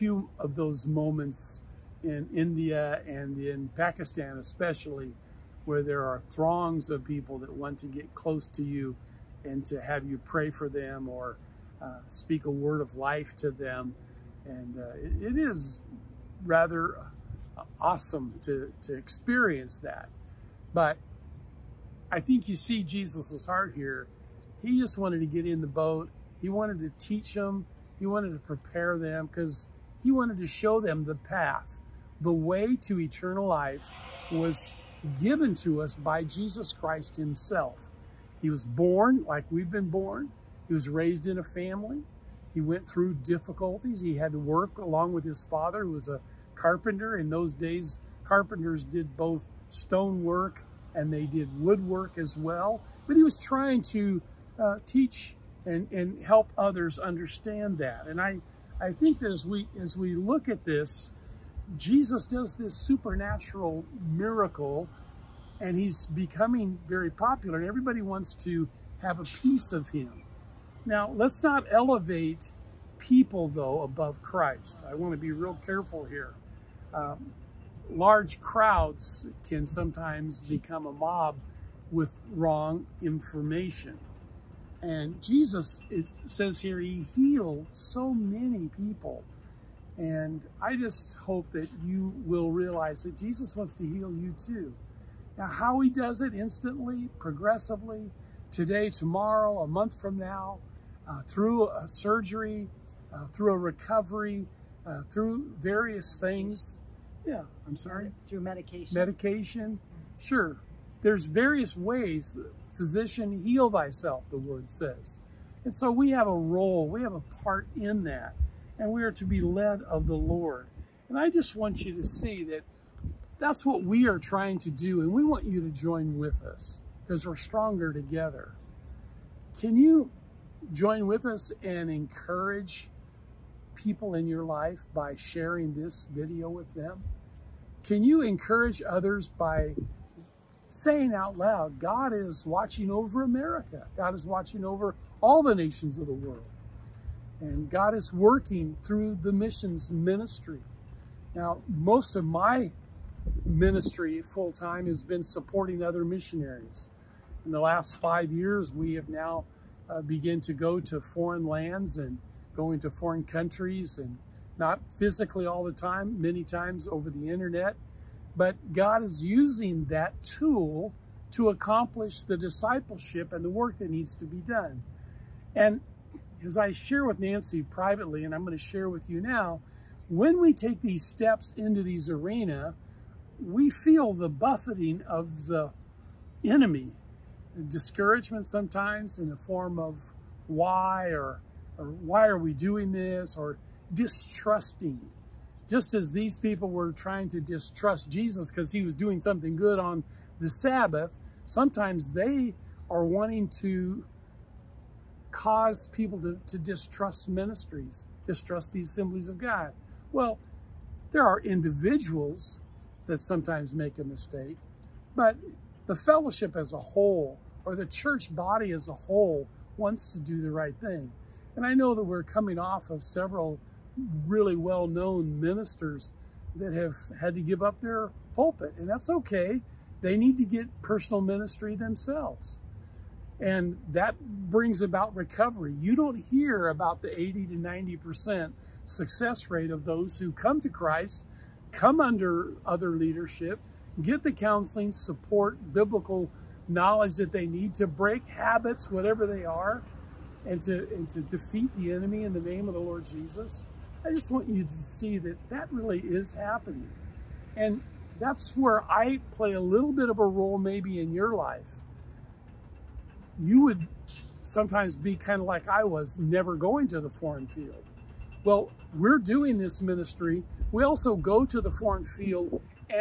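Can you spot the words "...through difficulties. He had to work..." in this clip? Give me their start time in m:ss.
0:42.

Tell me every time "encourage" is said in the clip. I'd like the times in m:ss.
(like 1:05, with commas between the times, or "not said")
2:11, 2:18.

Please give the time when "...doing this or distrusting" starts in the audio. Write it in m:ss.
3:12.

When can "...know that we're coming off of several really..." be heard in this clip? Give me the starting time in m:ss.
3:41.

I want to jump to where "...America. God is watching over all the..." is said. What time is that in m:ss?
2:23.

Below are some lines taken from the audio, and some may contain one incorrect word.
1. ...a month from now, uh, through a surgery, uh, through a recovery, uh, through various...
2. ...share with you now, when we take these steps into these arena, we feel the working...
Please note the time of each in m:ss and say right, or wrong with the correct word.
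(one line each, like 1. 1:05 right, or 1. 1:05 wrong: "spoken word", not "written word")
1. 1:39 right
2. 2:58 wrong: "buffeting", not "working".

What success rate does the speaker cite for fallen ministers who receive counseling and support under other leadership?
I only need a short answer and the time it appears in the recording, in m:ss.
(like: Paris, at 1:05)
80 to 90%, at 3:57.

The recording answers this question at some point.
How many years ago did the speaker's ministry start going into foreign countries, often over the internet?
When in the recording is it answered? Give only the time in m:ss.
2:38.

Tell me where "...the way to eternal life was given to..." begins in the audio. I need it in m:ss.
0:32.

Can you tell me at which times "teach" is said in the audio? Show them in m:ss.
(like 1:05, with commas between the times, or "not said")
0:27, 0:54.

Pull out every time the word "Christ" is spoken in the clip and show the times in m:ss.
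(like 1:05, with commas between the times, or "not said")
0:36, 1:14, 4:00.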